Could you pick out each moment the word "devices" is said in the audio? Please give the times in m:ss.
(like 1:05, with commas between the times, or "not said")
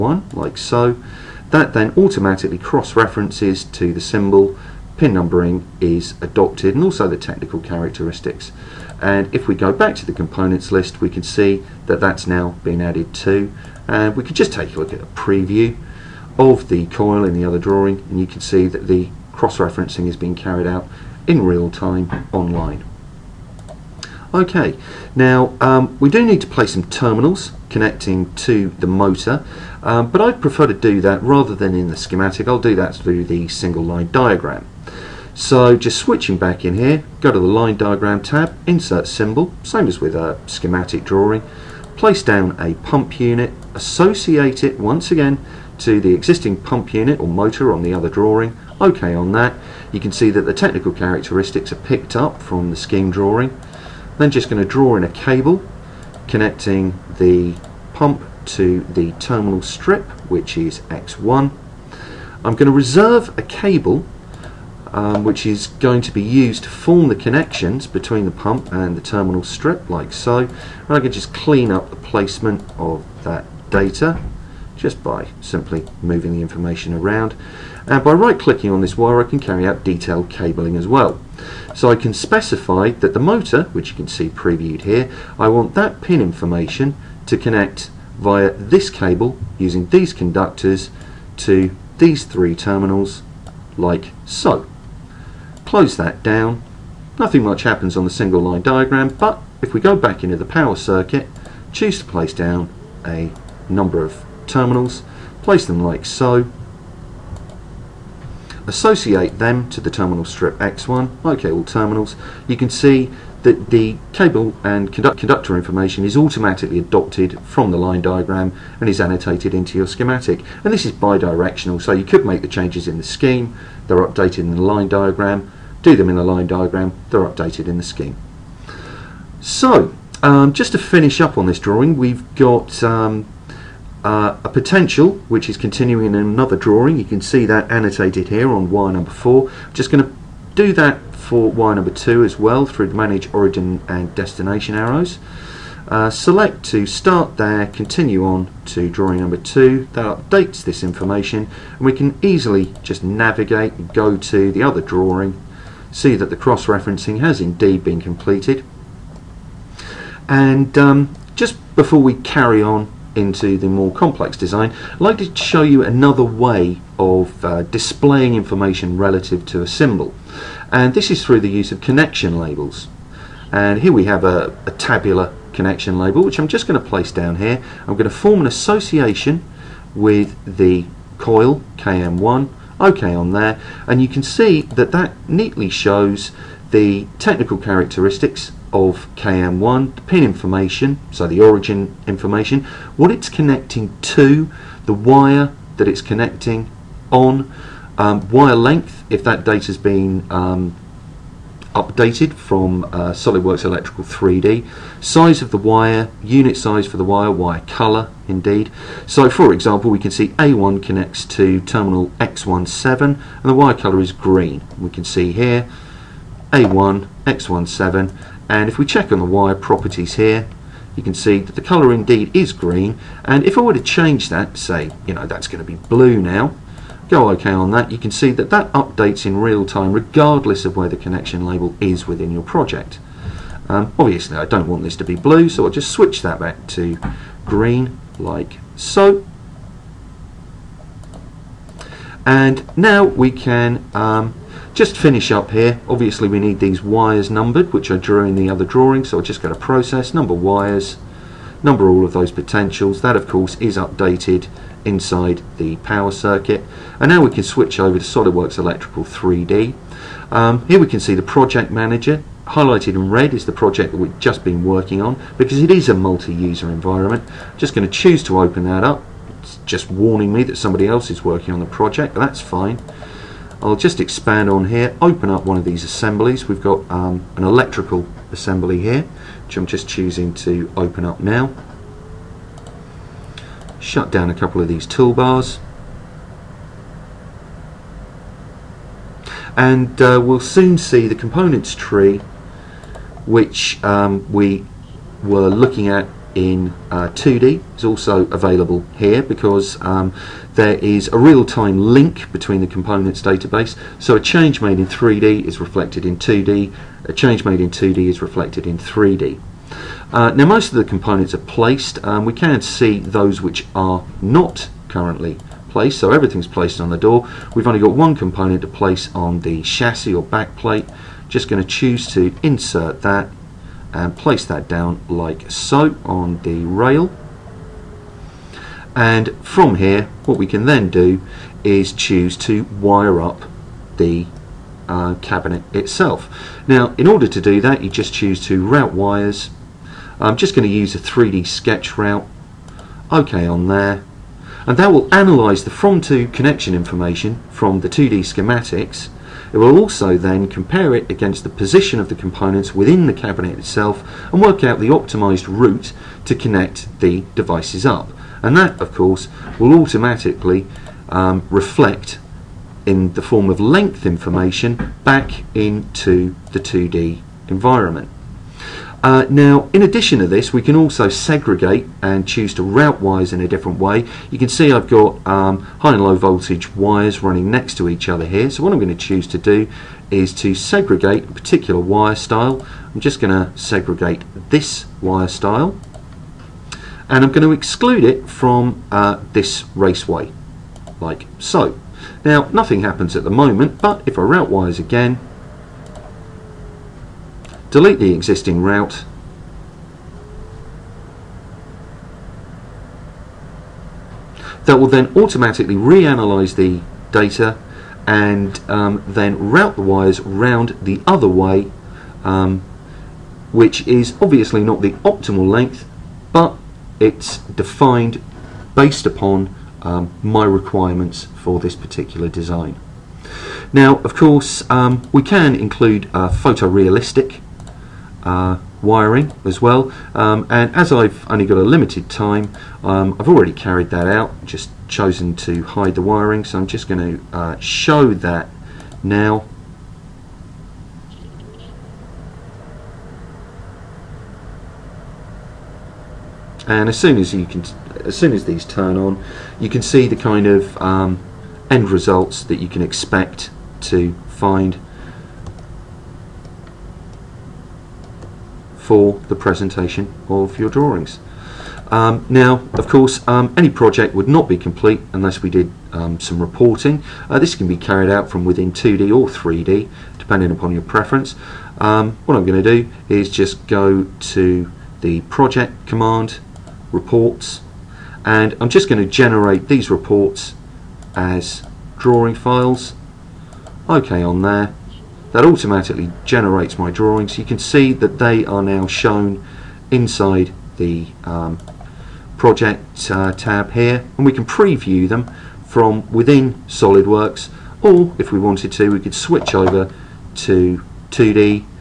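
5:57.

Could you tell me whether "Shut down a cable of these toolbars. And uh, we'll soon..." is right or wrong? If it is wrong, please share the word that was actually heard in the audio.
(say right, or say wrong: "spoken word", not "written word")
wrong: "couple", not "cable".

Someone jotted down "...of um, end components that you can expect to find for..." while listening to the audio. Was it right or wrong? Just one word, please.
wrong.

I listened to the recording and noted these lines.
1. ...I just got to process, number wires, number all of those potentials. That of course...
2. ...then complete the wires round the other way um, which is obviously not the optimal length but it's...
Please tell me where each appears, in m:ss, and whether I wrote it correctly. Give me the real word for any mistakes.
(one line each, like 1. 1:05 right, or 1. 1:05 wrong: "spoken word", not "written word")
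1. 4:09 right
2. 6:49 wrong: "route", not "complete".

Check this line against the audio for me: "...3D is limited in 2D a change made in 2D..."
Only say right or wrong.
wrong.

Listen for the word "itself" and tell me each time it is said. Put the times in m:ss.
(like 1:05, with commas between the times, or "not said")
5:35, 5:53.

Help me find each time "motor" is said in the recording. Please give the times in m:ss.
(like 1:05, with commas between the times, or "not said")
0:28, 0:47, 1:23.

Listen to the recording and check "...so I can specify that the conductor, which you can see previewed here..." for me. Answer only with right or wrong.
wrong.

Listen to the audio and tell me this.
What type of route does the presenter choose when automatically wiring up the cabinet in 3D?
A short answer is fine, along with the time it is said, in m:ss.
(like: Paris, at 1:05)
3D sketch route, at 5:40.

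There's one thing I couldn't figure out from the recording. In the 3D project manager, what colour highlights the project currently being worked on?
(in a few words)
Red.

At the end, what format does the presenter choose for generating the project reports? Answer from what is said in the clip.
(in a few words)
Drawing files.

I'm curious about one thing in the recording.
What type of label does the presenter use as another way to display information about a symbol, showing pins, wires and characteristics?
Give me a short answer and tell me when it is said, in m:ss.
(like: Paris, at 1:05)
Connection labels, at 2:51.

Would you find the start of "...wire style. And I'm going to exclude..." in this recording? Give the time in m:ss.
6:25.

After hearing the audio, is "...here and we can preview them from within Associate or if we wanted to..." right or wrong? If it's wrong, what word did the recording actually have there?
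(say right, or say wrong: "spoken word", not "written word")
wrong: "SolidWorks", not "Associate".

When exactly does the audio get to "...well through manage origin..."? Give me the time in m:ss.
2:22.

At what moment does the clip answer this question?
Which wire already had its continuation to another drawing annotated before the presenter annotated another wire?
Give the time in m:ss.
2:18.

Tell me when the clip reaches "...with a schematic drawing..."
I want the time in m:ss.
0:39.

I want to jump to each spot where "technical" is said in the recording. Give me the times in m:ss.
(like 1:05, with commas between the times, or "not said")
0:07, 0:50, 3:07.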